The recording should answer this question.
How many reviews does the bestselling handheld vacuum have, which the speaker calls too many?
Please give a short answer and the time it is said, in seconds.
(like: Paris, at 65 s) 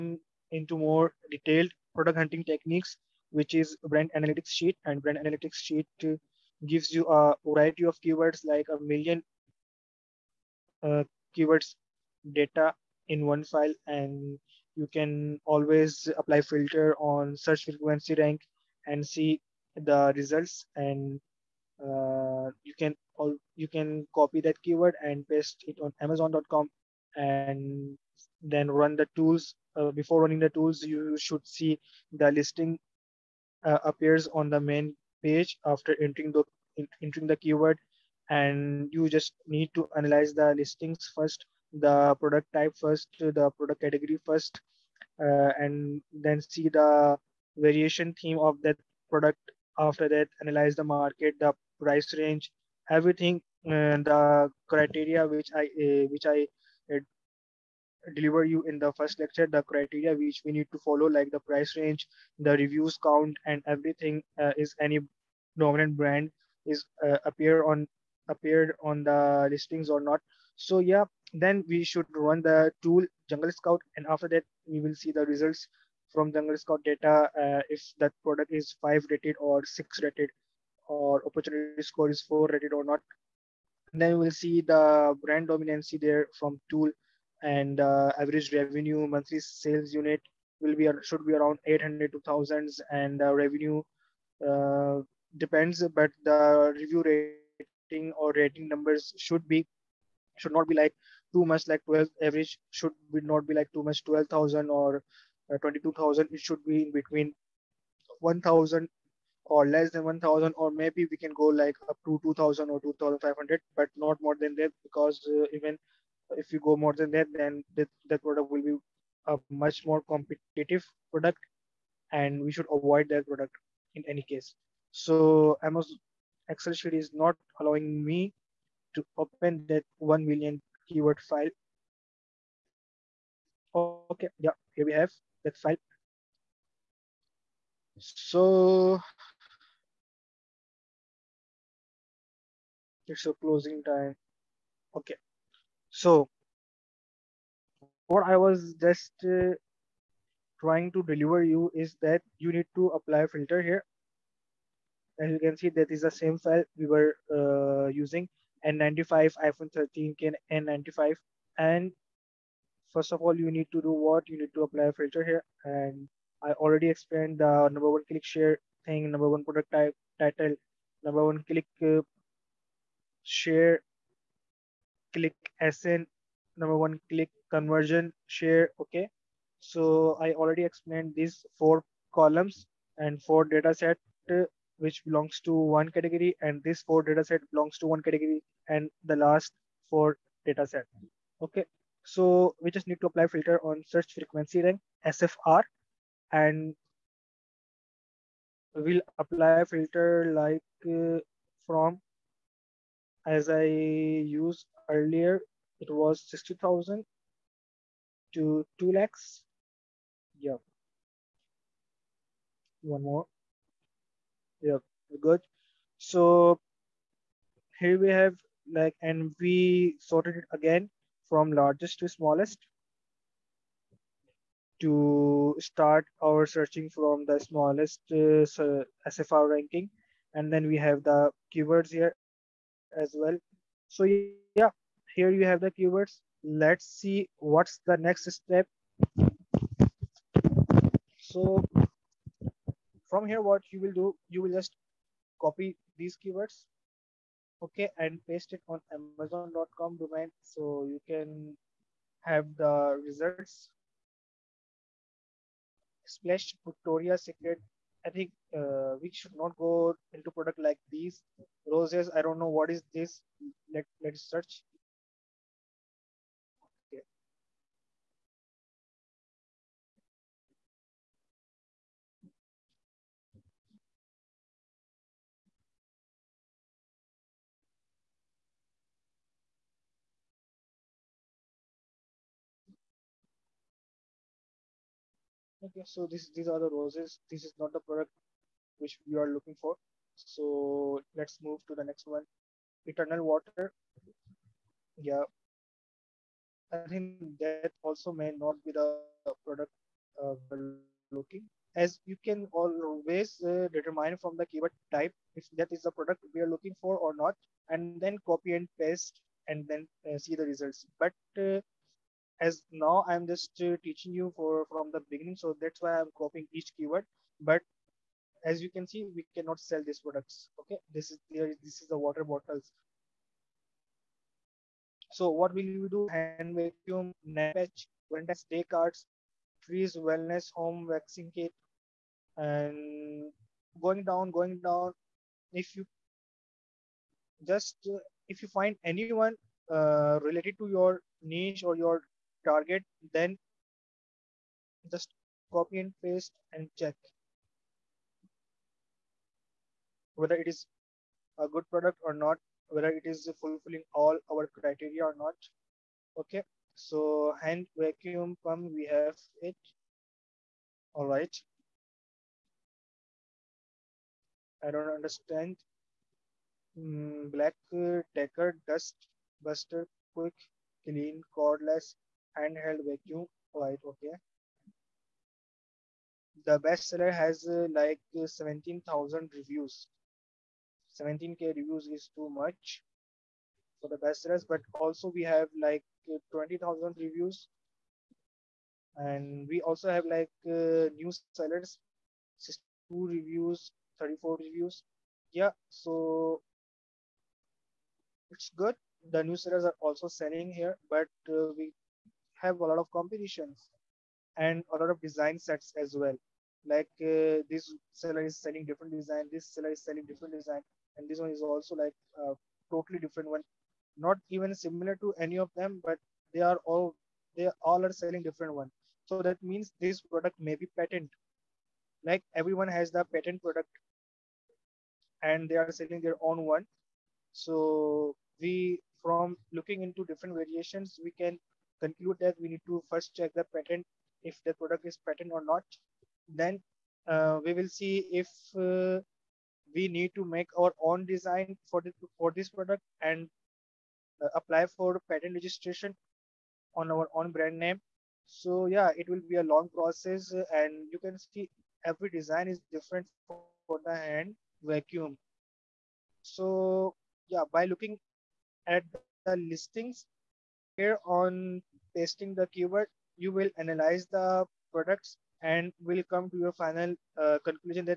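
17,000, at 378 s.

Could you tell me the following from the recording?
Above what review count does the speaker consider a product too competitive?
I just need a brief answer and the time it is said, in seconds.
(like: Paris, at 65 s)
2500, at 112 s.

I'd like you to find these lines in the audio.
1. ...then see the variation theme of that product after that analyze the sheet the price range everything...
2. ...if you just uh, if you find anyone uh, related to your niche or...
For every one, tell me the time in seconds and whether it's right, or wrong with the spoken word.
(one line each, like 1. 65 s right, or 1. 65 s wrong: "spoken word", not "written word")
1. 46 s wrong: "market", not "sheet"
2. 335 s right.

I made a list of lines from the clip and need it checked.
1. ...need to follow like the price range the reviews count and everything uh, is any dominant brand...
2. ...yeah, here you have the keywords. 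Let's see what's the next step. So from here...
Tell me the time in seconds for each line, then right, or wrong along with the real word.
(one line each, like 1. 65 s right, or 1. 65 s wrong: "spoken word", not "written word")
1. 60 s right
2. 234 s right.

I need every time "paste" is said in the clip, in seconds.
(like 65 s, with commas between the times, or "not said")
25 s, 248 s, 308 s, 346 s.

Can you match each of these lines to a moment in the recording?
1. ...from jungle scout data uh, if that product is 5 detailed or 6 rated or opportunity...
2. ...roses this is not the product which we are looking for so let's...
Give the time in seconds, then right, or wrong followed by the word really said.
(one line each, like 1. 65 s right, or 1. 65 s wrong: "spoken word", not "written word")
1. 76 s wrong: "rated", not "detailed"
2. 286 s right.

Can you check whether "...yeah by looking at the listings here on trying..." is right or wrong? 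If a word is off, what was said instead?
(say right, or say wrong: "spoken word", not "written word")
wrong: "testing", not "trying".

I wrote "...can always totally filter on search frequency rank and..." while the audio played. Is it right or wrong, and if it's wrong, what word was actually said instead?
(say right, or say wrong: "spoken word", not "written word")
wrong: "apply", not "totally".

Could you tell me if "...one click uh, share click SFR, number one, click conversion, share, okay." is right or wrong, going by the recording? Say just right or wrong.
wrong.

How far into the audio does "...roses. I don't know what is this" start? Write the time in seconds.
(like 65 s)
261 s.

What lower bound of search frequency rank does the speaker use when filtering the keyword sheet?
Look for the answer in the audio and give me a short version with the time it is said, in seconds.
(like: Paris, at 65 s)
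60,000, at 206 s.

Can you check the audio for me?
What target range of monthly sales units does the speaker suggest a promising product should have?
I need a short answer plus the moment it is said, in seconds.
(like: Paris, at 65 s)
800 to 1000, at 91 s.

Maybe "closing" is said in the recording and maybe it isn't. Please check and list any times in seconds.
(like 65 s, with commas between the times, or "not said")
143 s.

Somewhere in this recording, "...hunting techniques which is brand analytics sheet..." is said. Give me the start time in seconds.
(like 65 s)
2 s.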